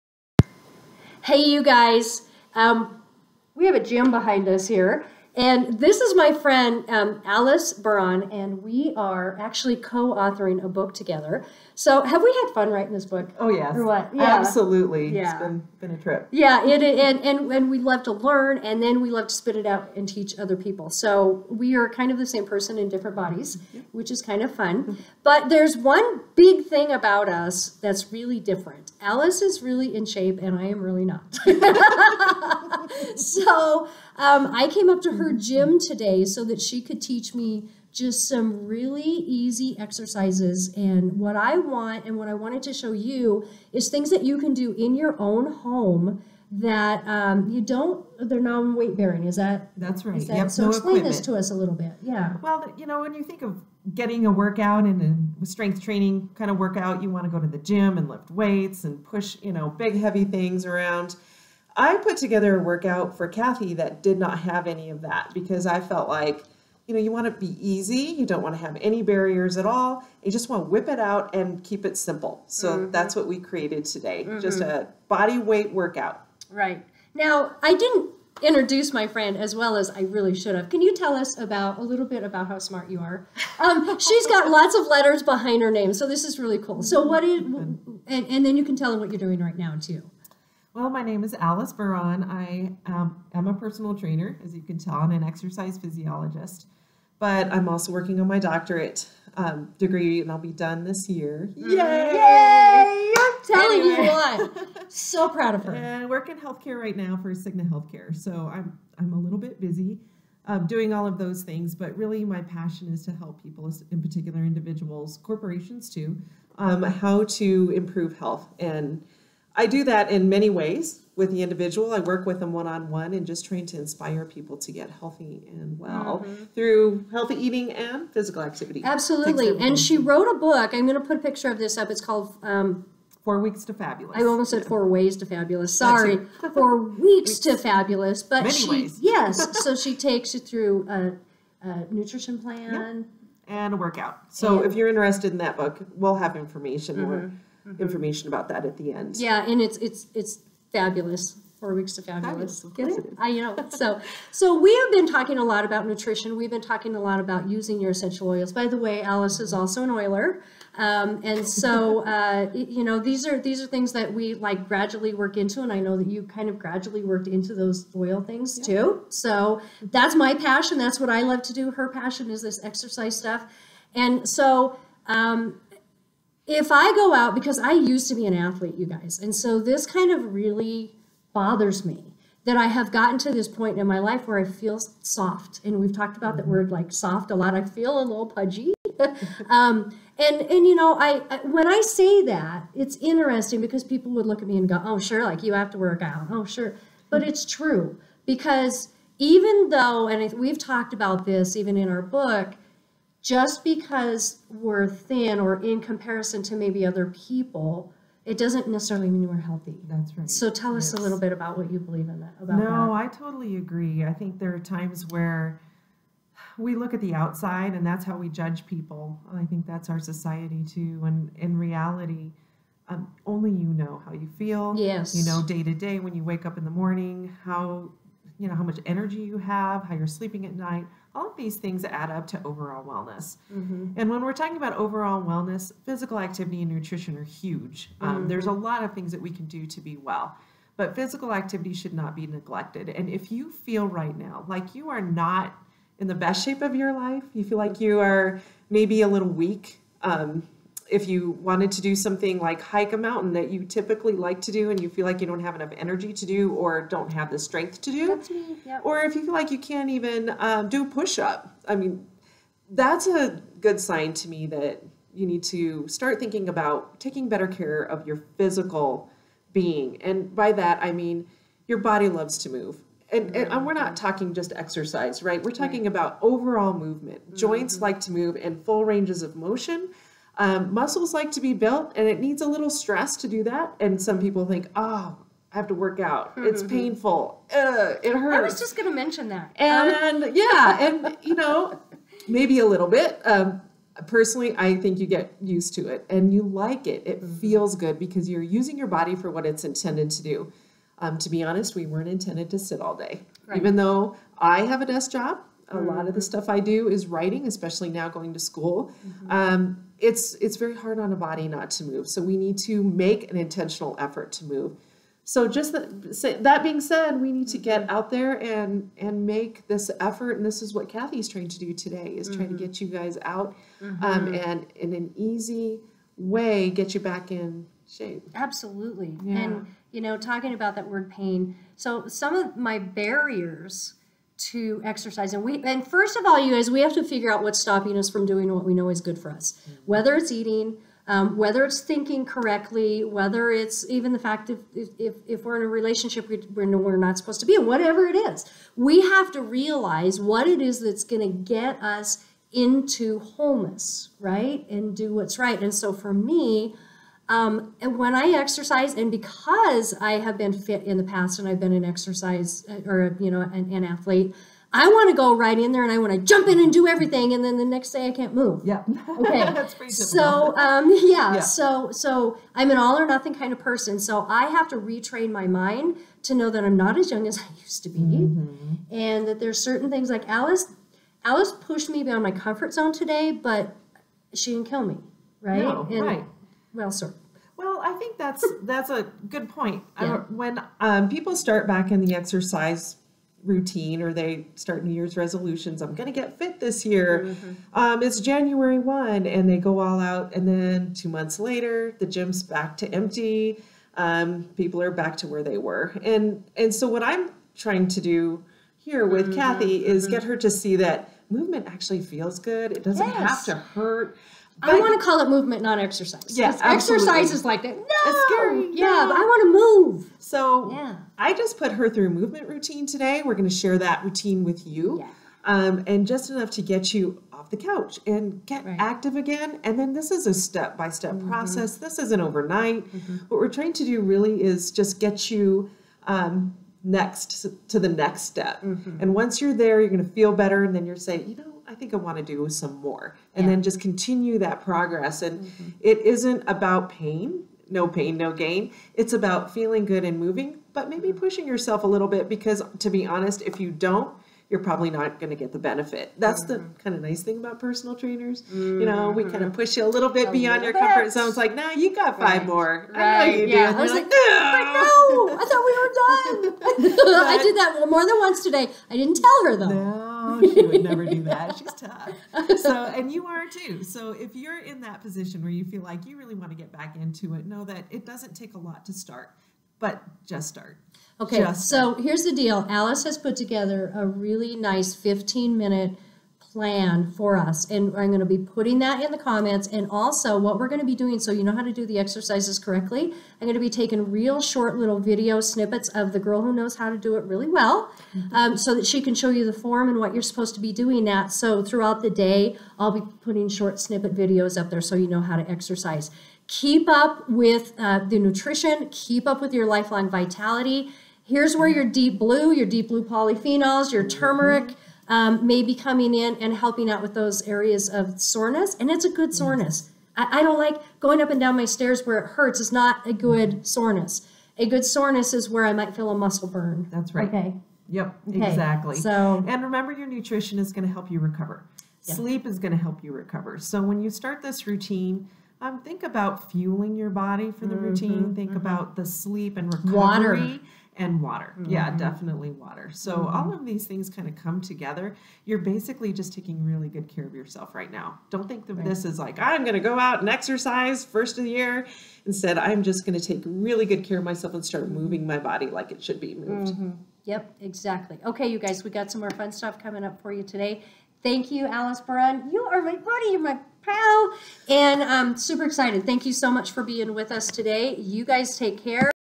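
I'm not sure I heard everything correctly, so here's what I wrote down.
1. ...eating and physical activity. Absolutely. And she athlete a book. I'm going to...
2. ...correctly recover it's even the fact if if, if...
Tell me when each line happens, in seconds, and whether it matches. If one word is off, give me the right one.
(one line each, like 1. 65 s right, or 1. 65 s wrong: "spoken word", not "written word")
1. 127 s wrong: "wrote", not "athlete"
2. 342 s wrong: "whether", not "recover".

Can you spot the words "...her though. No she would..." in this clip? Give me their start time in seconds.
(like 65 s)
469 s.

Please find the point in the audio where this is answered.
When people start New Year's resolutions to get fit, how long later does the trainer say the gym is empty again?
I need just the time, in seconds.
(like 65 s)
400 s.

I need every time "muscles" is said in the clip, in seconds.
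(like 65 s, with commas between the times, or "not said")
280 s, 526 s.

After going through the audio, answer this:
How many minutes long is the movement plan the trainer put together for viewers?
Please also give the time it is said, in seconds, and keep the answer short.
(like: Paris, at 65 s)
15, at 484 s.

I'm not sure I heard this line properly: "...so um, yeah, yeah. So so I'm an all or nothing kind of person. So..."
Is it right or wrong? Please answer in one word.
right.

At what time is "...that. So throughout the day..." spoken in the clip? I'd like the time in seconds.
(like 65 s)
501 s.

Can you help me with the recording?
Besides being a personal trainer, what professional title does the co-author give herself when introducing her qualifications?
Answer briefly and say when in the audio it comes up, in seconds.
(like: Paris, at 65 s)
Exercise physiologist, at 95 s.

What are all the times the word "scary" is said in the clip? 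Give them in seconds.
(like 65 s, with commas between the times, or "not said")
418 s.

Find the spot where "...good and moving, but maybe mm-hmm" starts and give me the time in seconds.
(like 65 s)
449 s.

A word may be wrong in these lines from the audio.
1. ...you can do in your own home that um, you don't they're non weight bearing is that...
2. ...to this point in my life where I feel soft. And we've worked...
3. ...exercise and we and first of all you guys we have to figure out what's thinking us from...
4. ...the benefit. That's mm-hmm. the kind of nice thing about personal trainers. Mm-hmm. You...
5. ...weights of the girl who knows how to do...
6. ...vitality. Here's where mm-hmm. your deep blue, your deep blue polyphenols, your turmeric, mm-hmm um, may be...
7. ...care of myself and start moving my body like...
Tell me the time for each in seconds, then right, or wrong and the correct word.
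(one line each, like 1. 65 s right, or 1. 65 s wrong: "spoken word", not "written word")
1. 44 s right
2. 183 s wrong: "talked", not "worked"
3. 334 s wrong: "stopping", not "thinking"
4. 455 s right
5. 495 s wrong: "snippets", not "weights"
6. 510 s right
7. 554 s right.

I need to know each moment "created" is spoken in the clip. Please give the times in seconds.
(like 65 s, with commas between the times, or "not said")
73 s.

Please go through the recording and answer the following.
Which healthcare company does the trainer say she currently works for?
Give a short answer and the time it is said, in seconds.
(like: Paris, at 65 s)
Cigna Healthcare, at 107 s.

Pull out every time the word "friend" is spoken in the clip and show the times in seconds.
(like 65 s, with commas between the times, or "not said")
6 s, 79 s.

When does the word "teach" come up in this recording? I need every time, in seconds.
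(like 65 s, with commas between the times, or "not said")
20 s, 37 s.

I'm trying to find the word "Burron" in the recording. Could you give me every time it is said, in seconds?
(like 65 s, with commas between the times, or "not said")
7 s, 91 s, 562 s.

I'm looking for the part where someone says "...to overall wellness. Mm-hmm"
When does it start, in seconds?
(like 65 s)
232 s.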